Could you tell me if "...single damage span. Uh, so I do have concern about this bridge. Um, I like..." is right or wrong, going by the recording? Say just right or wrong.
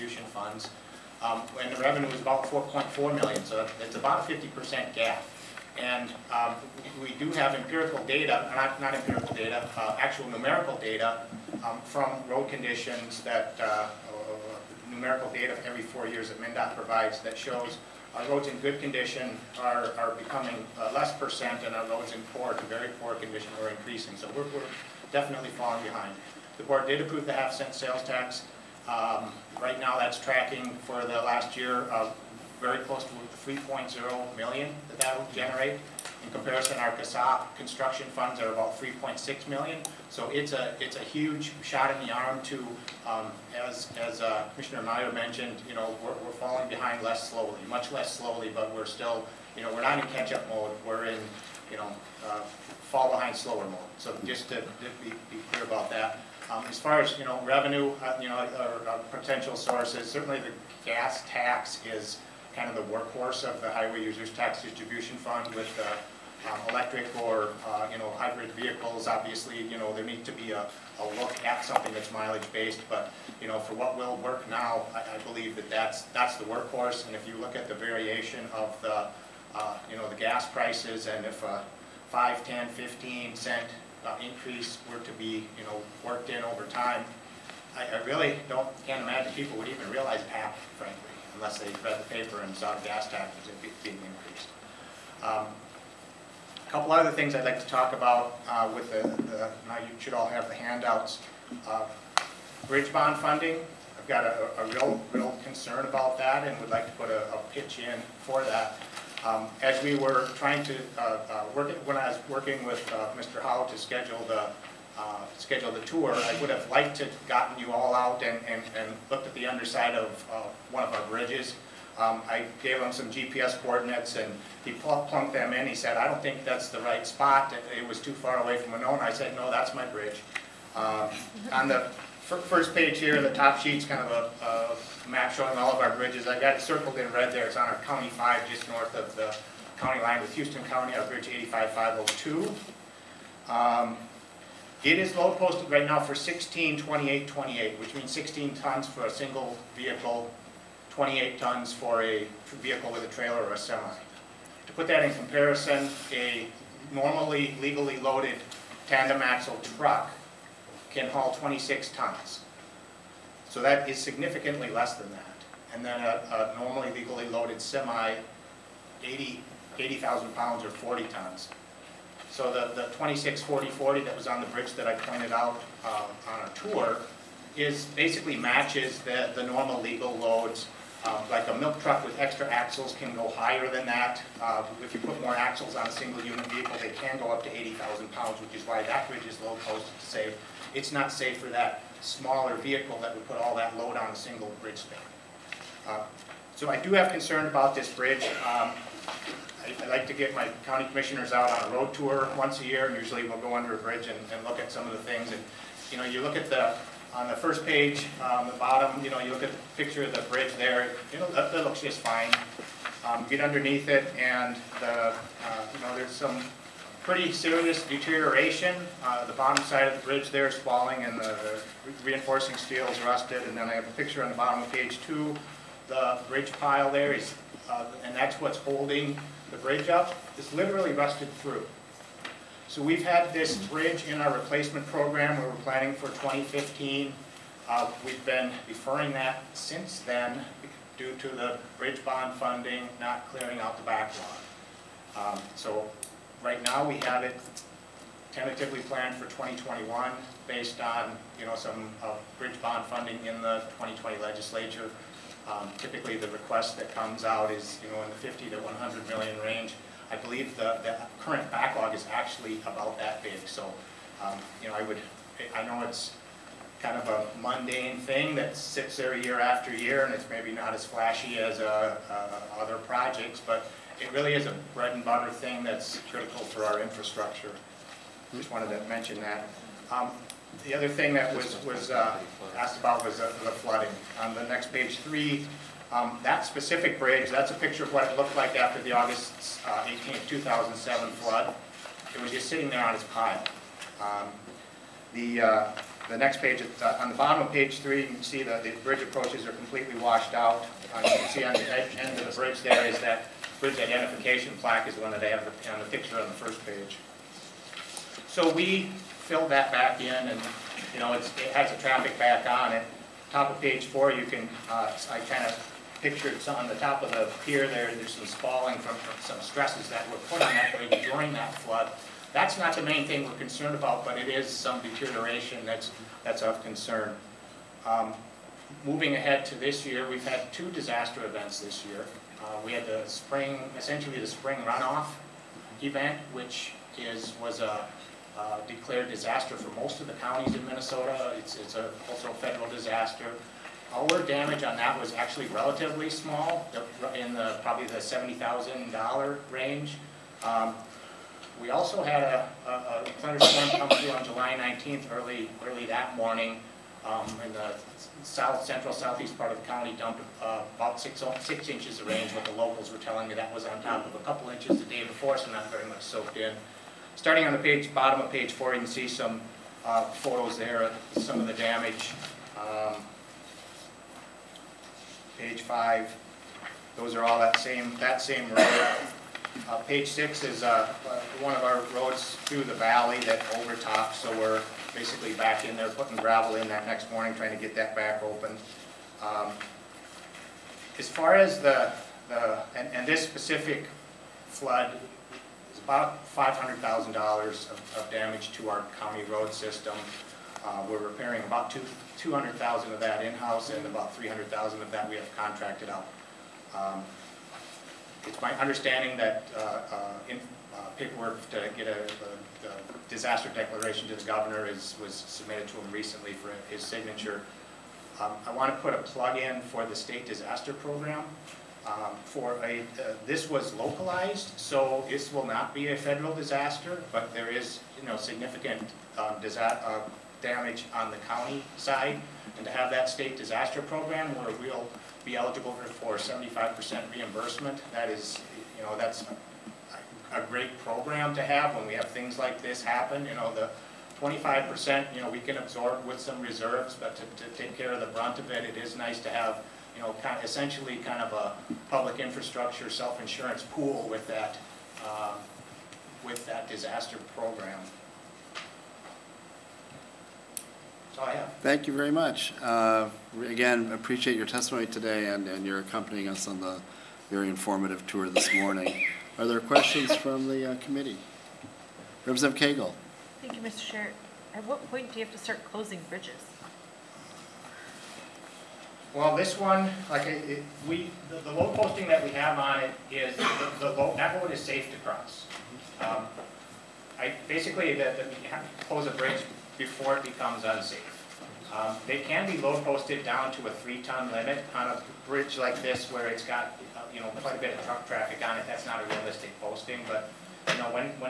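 wrong.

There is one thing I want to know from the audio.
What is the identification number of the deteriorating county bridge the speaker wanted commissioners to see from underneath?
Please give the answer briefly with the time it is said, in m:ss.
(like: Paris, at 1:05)
85502, at 2:21.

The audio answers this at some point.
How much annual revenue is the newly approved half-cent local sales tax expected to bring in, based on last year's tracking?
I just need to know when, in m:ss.
0:33.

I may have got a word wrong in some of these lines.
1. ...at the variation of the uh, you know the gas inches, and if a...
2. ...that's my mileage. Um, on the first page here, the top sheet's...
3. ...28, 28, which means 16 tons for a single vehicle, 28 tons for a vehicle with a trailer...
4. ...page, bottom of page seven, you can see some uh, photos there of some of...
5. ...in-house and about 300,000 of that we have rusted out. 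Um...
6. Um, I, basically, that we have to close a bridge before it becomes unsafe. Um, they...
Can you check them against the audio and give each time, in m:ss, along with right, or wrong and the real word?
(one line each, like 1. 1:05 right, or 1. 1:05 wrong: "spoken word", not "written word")
1. 1:17 wrong: "prices", not "inches"
2. 2:09 wrong: "bridge", not "mileage"
3. 2:26 right
4. 6:07 wrong: "four", not "seven"
5. 6:43 wrong: "contracted", not "rusted"
6. 8:05 right.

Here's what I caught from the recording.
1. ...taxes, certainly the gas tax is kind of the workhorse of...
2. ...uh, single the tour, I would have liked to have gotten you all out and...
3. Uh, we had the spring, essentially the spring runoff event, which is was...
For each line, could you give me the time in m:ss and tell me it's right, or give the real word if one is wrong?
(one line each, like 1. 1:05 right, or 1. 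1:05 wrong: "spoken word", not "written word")
1. 0:59 wrong: "sources", not "taxes"
2. 1:54 wrong: "schedule", not "single"
3. 5:32 right.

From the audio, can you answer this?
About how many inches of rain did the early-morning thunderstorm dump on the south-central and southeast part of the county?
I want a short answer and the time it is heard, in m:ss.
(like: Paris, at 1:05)
6 inches, at 6:01.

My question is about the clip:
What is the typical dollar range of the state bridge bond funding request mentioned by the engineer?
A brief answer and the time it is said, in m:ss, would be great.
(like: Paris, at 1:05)
50 to 100 million, at 4:18.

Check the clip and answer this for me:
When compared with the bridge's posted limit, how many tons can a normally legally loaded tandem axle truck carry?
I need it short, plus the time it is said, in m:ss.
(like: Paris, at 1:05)
26 tons, at 2:41.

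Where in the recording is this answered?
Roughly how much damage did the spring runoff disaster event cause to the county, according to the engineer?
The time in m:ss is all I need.
5:47.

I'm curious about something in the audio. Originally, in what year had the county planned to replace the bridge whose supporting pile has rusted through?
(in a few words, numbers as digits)
2015.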